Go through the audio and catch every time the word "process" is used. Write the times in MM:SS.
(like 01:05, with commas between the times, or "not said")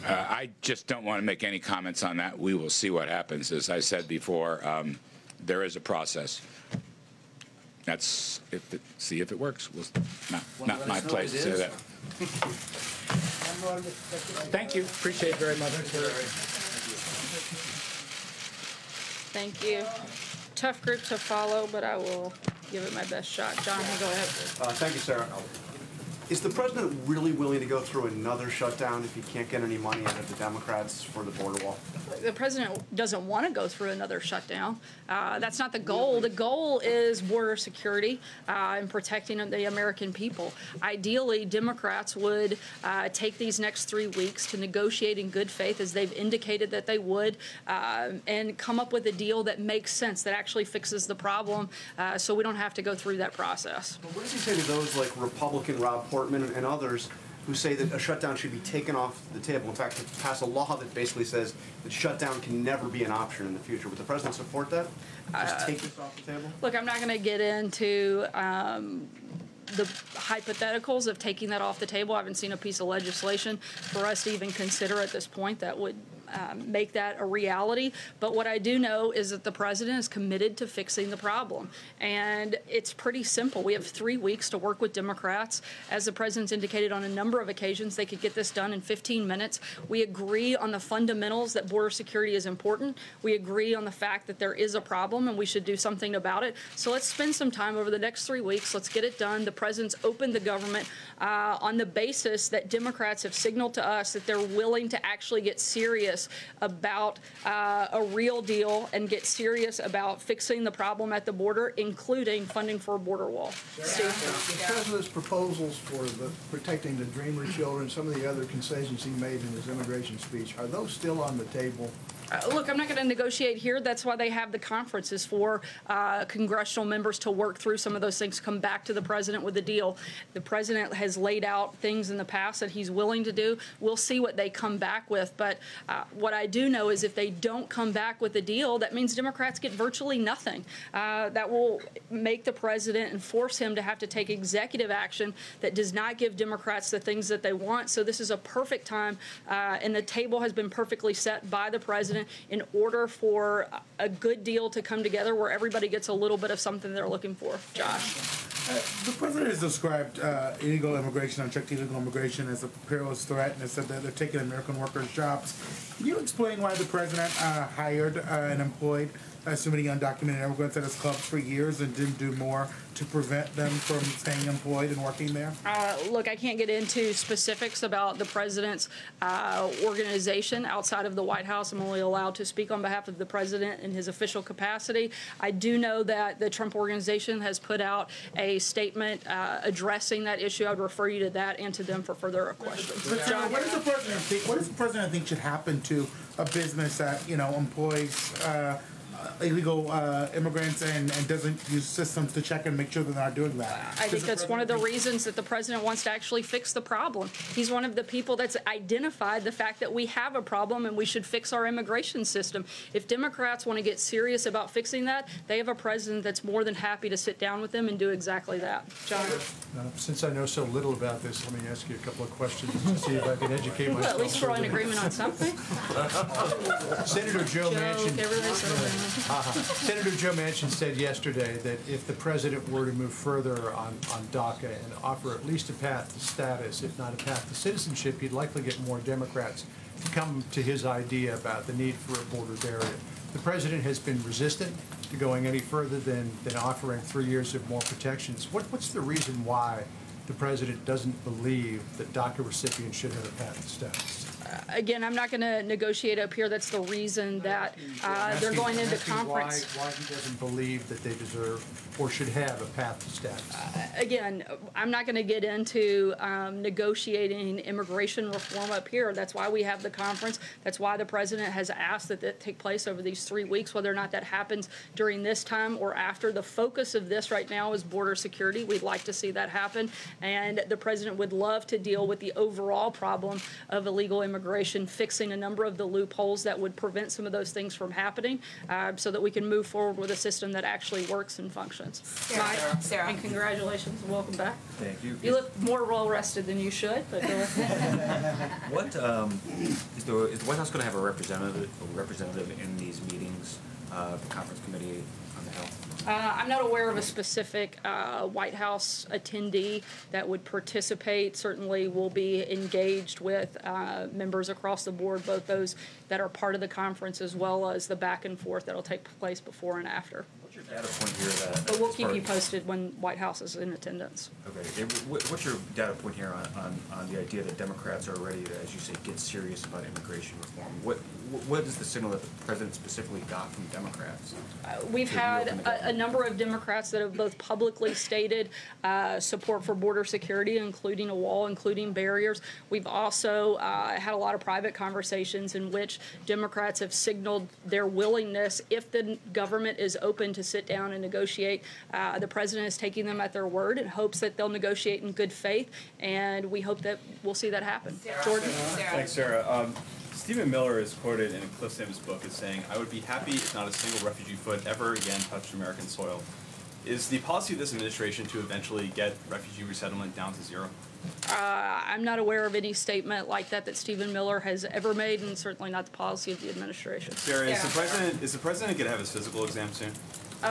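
00:05, 00:53.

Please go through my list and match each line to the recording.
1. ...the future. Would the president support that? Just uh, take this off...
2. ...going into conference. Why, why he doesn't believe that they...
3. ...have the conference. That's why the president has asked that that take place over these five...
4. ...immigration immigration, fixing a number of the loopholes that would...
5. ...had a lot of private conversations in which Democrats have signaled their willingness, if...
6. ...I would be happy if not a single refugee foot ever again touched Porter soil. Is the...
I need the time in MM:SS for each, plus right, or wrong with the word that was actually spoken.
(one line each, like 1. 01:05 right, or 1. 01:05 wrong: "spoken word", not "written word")
1. 01:03 right
2. 04:18 right
3. 04:29 wrong: "three", not "five"
4. 04:44 right
5. 05:43 right
6. 06:02 wrong: "American", not "Porter".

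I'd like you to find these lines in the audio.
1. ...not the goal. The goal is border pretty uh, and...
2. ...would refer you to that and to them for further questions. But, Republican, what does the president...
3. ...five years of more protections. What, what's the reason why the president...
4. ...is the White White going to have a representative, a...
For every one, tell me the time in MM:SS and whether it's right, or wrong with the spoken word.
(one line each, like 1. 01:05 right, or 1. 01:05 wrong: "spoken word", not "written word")
1. 00:35 wrong: "security", not "pretty"
2. 03:10 wrong: "John", not "Republican"
3. 04:07 wrong: "three", not "five"
4. 05:00 wrong: "House", not "White".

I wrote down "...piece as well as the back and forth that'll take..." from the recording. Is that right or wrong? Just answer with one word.
wrong.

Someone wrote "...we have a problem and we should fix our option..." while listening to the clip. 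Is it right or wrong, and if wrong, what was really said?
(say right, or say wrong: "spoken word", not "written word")
wrong: "immigration", not "option".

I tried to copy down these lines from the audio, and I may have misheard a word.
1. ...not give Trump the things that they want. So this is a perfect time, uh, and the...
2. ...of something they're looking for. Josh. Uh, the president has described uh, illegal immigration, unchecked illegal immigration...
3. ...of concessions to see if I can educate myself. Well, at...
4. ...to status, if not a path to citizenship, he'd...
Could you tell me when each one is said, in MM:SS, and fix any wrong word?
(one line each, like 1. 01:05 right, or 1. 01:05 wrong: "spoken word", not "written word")
1. 02:25 wrong: "Democrats", not "Trump"
2. 02:36 right
3. 03:42 wrong: "questions", not "concessions"
4. 03:56 right.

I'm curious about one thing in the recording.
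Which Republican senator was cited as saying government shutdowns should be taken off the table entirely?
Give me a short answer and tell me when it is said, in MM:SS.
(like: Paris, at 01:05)
Portman, at 00:56.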